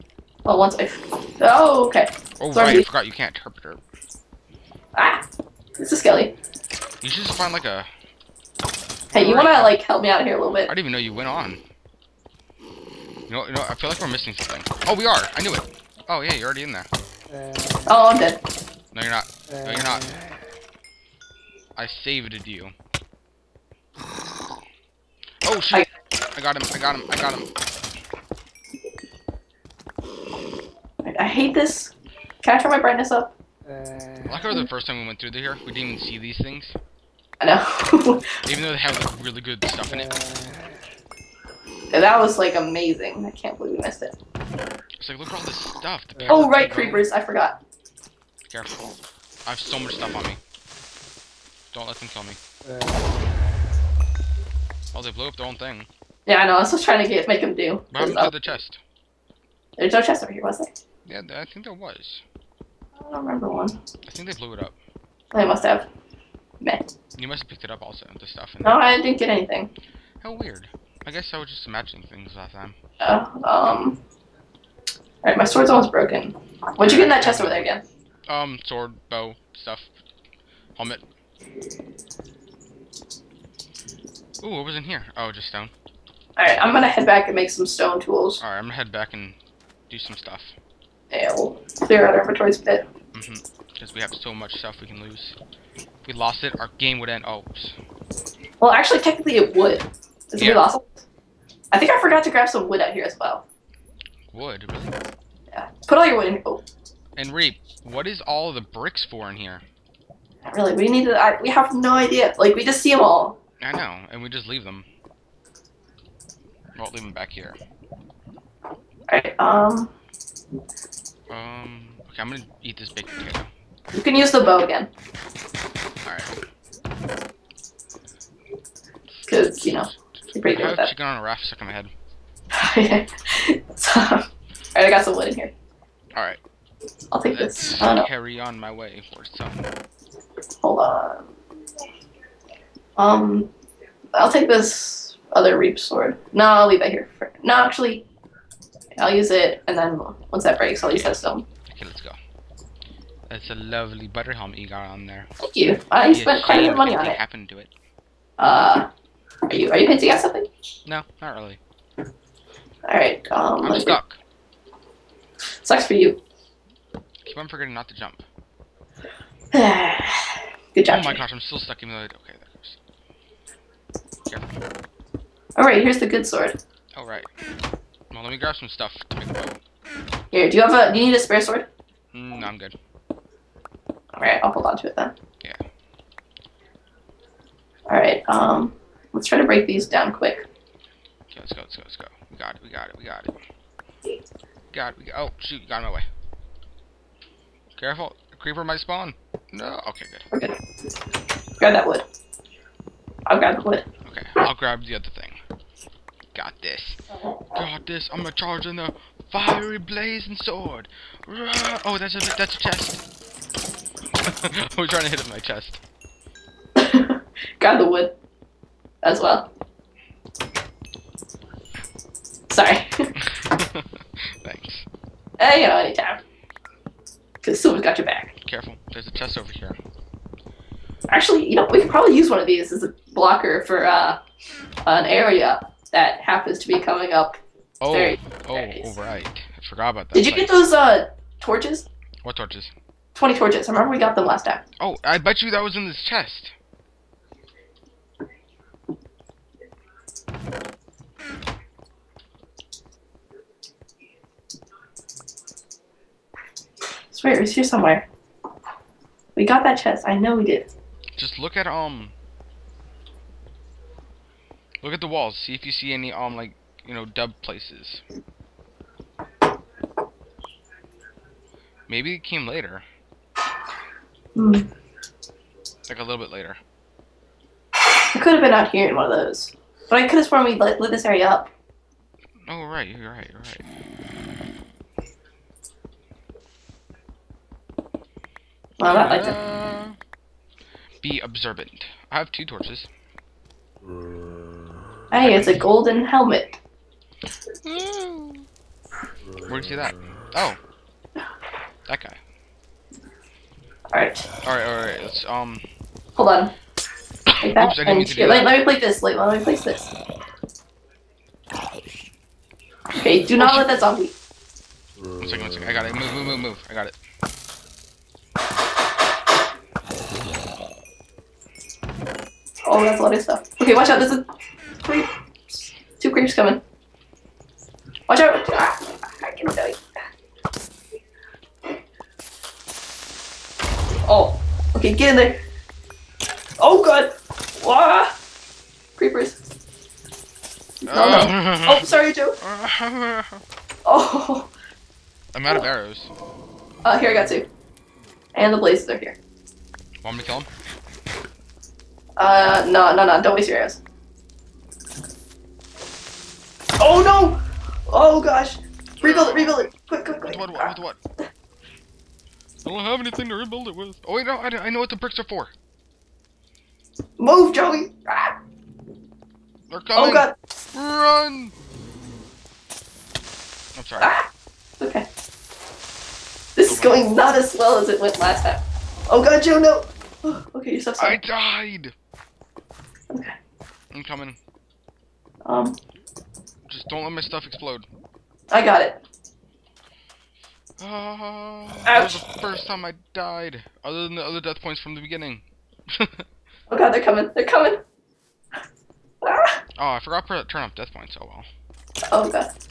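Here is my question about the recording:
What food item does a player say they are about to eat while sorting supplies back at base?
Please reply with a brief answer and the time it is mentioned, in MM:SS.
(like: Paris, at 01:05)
Big potato, at 02:02.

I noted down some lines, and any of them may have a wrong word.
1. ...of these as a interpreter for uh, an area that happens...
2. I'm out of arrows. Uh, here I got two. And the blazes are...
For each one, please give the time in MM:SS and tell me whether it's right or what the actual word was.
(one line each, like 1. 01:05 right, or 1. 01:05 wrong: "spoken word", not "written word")
1. 03:52 wrong: "blocker", not "interpreter"
2. 05:45 right.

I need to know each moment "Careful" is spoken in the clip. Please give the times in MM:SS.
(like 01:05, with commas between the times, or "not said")
00:48, 03:17, 03:48.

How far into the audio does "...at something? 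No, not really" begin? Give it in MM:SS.
02:40.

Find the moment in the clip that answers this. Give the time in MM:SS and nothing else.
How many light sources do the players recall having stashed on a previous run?
04:03.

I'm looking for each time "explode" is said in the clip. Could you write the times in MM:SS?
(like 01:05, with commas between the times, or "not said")
06:27.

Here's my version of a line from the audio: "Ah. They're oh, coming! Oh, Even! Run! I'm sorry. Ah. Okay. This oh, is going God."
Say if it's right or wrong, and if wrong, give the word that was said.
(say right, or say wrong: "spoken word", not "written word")
wrong: "God", not "Even".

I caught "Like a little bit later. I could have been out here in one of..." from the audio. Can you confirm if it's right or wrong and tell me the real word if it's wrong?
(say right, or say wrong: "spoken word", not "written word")
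right.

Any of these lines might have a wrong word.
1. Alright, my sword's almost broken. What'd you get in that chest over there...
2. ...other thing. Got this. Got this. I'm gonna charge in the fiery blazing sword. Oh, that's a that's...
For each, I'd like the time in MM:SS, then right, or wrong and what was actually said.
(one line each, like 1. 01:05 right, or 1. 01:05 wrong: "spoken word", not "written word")
1. 01:15 right
2. 03:24 right.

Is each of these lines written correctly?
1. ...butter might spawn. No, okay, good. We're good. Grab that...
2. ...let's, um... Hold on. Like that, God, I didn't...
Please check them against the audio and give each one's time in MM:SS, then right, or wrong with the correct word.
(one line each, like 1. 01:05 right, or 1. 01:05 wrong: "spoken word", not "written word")
1. 03:18 wrong: "creeper", not "butter"
2. 05:05 wrong: "Oops", not "God".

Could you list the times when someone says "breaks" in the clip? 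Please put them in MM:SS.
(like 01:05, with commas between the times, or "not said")
02:30, 03:09.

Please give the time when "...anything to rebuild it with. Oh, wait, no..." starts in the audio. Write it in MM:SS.
06:02.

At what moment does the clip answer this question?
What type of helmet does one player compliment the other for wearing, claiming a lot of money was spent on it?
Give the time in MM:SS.
02:34.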